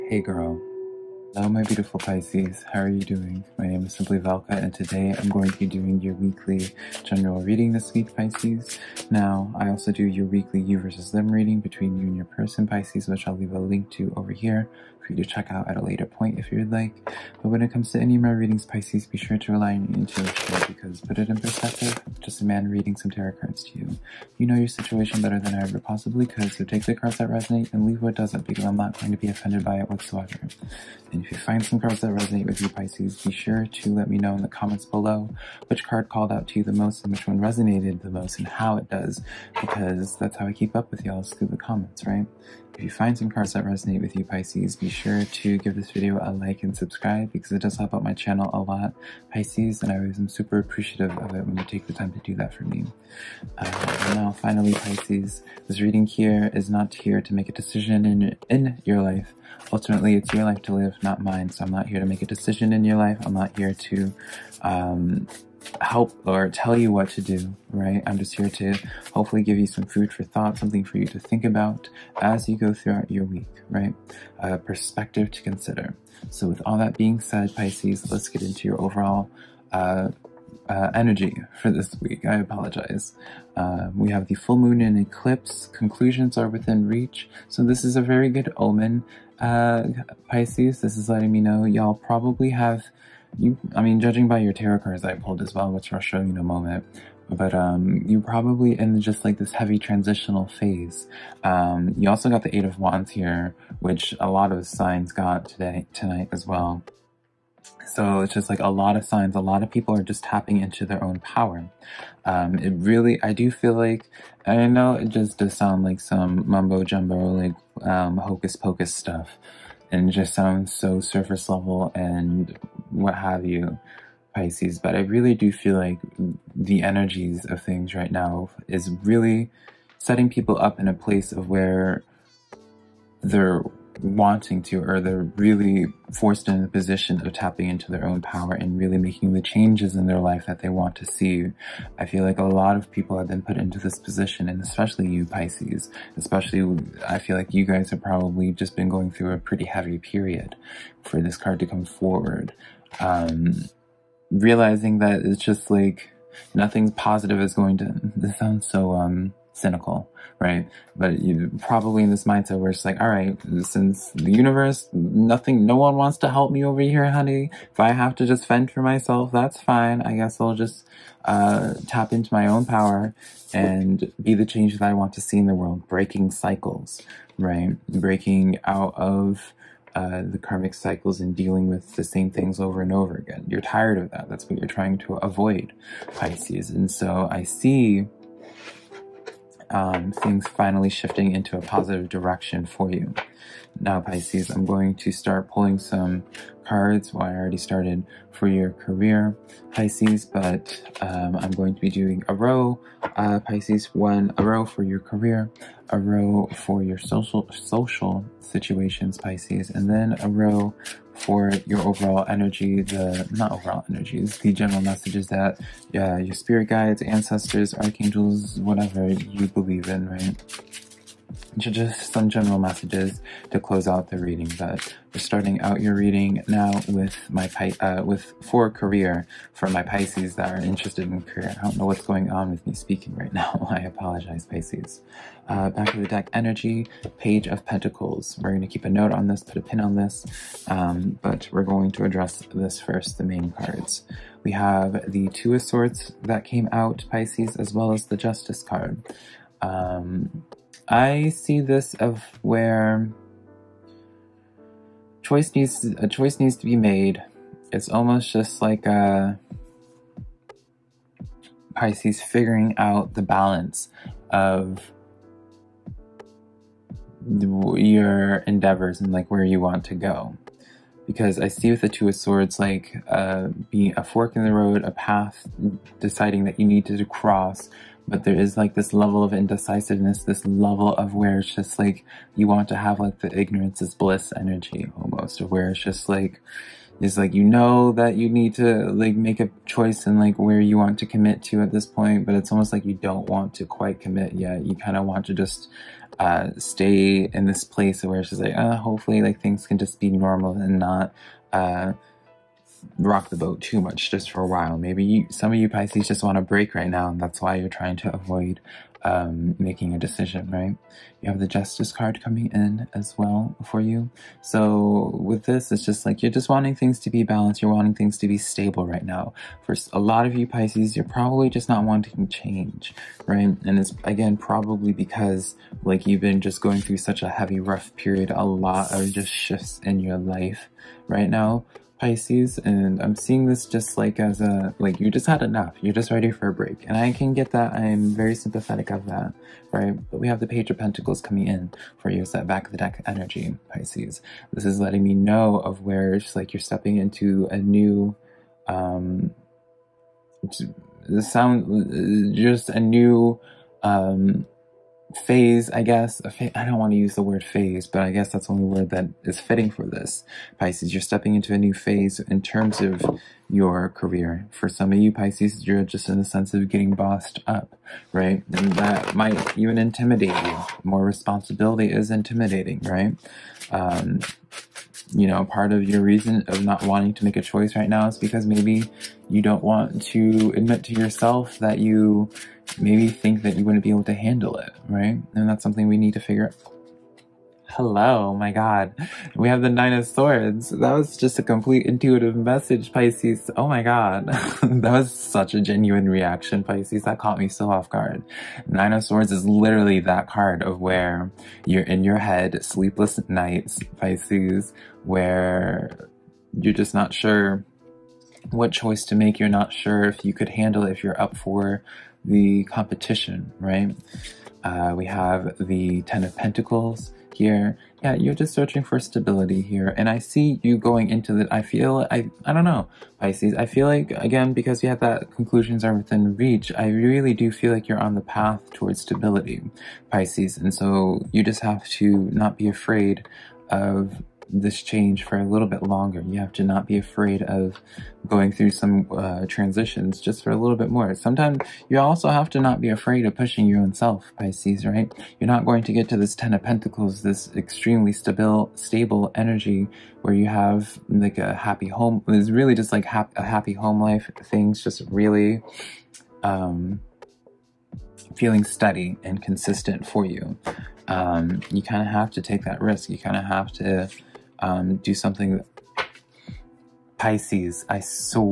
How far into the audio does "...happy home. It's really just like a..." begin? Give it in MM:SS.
07:31.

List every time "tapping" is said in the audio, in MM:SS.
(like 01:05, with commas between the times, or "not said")
01:50, 02:17.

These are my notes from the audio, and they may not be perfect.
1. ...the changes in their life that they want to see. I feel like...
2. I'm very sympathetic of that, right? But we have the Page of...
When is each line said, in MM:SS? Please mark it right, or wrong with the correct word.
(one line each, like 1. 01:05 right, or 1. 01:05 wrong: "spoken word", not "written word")
1. 02:19 right
2. 05:37 right.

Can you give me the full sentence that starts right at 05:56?
I don't want to use the word phase, but I guess that's the only word that is fitting for this.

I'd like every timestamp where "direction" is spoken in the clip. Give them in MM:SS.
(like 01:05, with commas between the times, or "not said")
03:12.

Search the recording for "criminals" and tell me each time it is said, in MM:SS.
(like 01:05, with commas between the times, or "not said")
not said.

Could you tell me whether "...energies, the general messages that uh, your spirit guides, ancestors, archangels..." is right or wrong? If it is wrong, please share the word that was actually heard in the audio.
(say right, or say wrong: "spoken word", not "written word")
right.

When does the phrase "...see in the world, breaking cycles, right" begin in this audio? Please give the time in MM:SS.
02:55.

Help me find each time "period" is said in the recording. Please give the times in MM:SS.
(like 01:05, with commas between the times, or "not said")
02:29, 05:27.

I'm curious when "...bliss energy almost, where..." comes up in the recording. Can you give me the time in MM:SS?
04:43.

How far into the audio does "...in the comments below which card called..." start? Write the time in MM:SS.
00:34.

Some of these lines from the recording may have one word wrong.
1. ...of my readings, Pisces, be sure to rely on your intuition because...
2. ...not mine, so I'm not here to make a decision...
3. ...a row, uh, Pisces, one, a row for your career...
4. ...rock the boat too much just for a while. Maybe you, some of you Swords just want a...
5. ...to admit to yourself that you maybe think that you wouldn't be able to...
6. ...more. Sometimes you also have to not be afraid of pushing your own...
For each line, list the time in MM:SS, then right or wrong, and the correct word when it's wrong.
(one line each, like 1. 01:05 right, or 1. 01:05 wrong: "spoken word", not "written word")
1. 00:18 right
2. 01:01 right
3. 03:22 right
4. 05:02 wrong: "Pisces", not "Swords"
5. 06:20 right
6. 07:20 right.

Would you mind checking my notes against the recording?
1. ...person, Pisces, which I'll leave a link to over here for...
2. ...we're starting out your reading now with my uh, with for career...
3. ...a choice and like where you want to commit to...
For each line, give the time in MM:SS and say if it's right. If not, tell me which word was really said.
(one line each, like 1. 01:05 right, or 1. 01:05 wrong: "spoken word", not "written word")
1. 00:12 right
2. 03:45 right
3. 04:49 right.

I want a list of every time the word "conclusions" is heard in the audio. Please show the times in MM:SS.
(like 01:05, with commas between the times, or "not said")
01:25, 07:05.